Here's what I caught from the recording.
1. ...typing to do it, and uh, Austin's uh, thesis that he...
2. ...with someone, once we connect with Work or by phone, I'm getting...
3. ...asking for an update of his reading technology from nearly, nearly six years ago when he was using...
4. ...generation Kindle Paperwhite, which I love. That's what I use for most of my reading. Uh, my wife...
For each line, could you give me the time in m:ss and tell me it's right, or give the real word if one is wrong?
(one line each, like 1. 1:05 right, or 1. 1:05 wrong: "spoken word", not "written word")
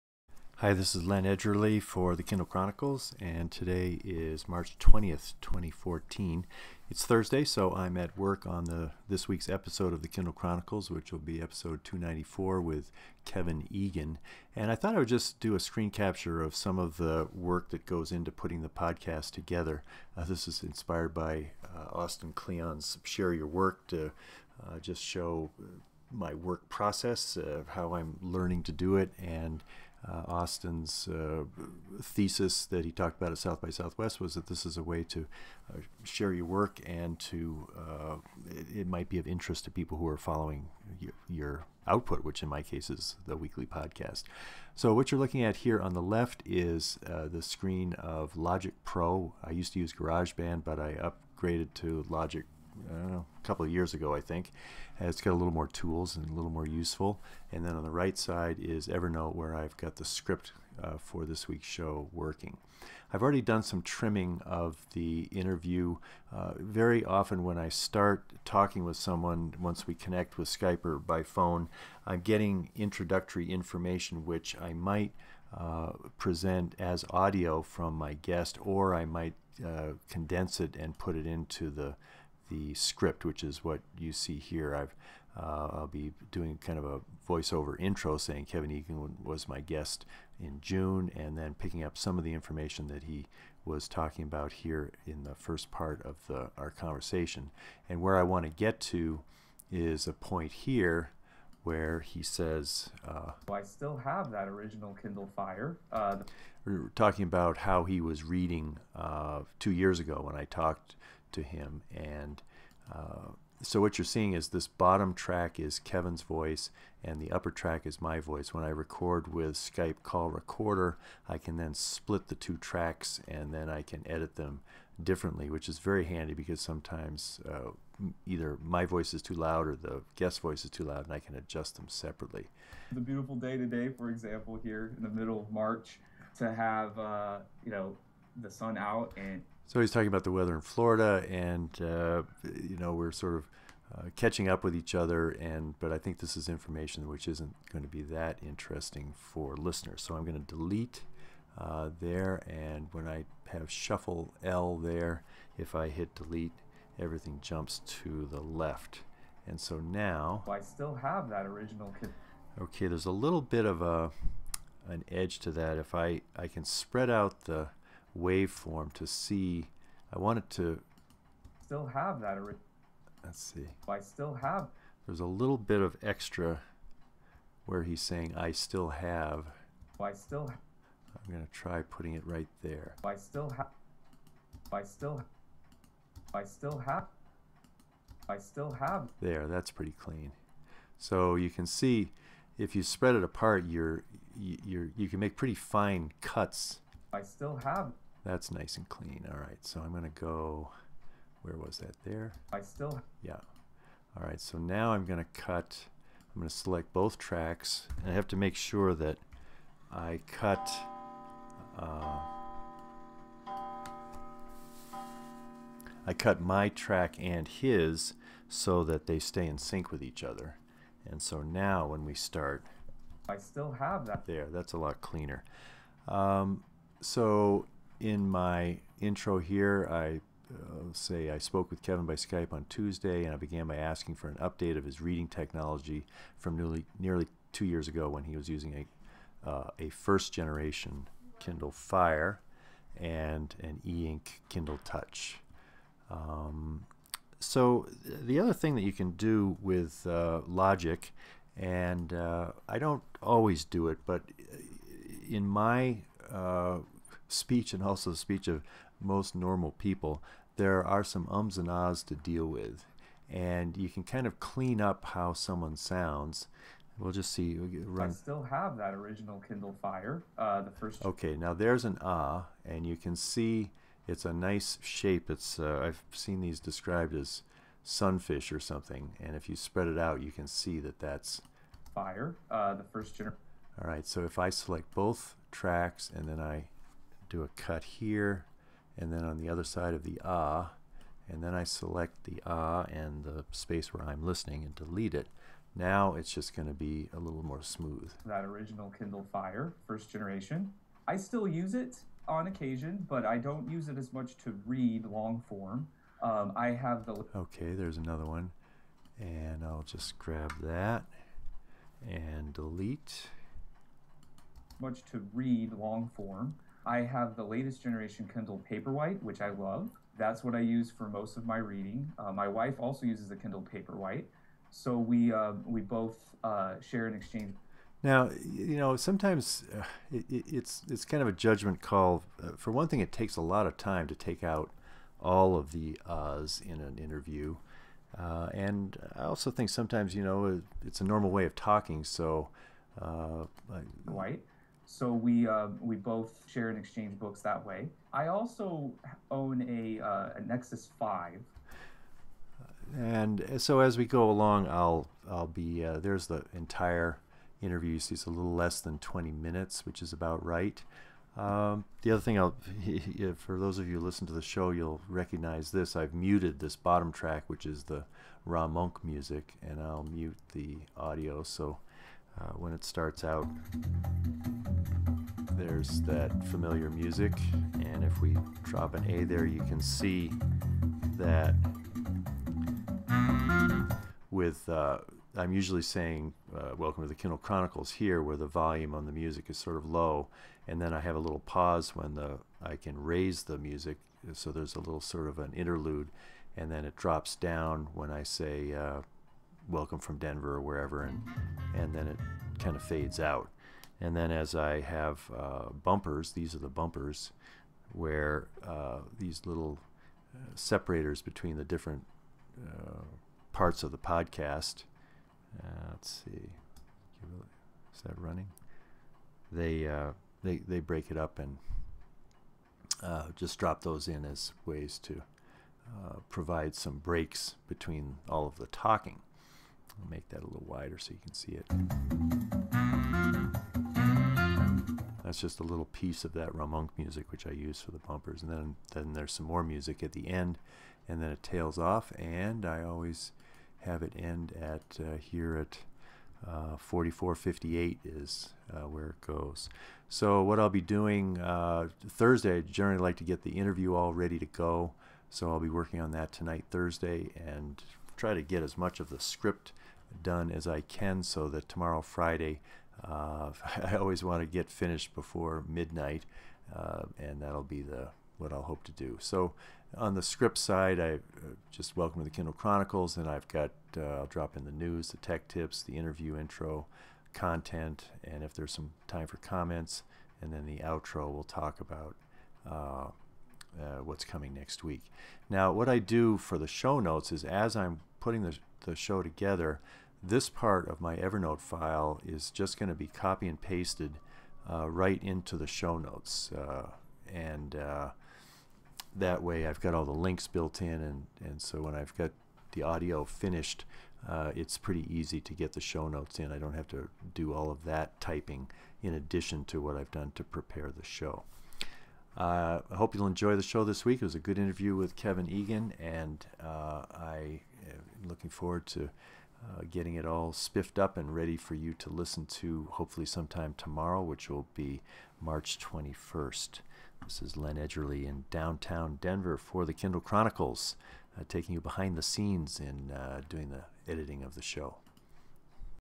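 1. 0:28 wrong: "learning", not "typing"
2. 1:08 wrong: "Skype", not "Work"
3. 3:53 wrong: "two", not "six"
4. 5:17 right.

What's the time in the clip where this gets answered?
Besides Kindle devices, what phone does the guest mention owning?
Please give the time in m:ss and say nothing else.
5:50.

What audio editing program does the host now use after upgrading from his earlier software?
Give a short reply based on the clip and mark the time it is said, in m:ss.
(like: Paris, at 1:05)
Logic Pro, at 0:48.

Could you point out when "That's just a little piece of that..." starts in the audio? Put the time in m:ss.
7:15.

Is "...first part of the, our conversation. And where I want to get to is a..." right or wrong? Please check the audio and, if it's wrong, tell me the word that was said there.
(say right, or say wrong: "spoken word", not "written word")
right.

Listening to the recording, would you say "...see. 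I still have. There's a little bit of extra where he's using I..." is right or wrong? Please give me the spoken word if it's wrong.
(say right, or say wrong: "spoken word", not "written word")
wrong: "saying", not "using".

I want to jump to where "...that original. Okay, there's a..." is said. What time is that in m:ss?
2:41.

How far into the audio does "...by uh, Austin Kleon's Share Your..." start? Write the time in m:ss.
0:21.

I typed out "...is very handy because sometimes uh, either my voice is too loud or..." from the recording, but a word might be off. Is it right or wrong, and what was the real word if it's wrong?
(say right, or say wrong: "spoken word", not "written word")
right.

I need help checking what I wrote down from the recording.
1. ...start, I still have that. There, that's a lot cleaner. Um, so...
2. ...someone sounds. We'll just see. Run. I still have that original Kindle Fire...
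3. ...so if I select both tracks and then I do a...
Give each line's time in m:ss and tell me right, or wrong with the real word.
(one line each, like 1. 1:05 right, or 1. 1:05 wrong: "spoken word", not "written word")
1. 3:42 right
2. 4:25 right
3. 4:44 right.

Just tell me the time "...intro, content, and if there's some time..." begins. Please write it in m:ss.
7:56.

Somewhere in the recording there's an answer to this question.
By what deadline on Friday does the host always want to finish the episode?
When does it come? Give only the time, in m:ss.
7:45.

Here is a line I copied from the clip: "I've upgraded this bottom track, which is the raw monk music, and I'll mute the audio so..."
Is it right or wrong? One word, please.
wrong.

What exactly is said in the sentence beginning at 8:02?
Uh, uh, what's coming next week.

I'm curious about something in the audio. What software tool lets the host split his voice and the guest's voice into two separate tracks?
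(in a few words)
Skype Call Recorder.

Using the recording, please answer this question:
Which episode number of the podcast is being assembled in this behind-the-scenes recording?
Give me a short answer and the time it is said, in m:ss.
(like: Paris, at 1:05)
294, at 0:11.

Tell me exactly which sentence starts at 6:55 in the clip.
Uh, let's see, is that running?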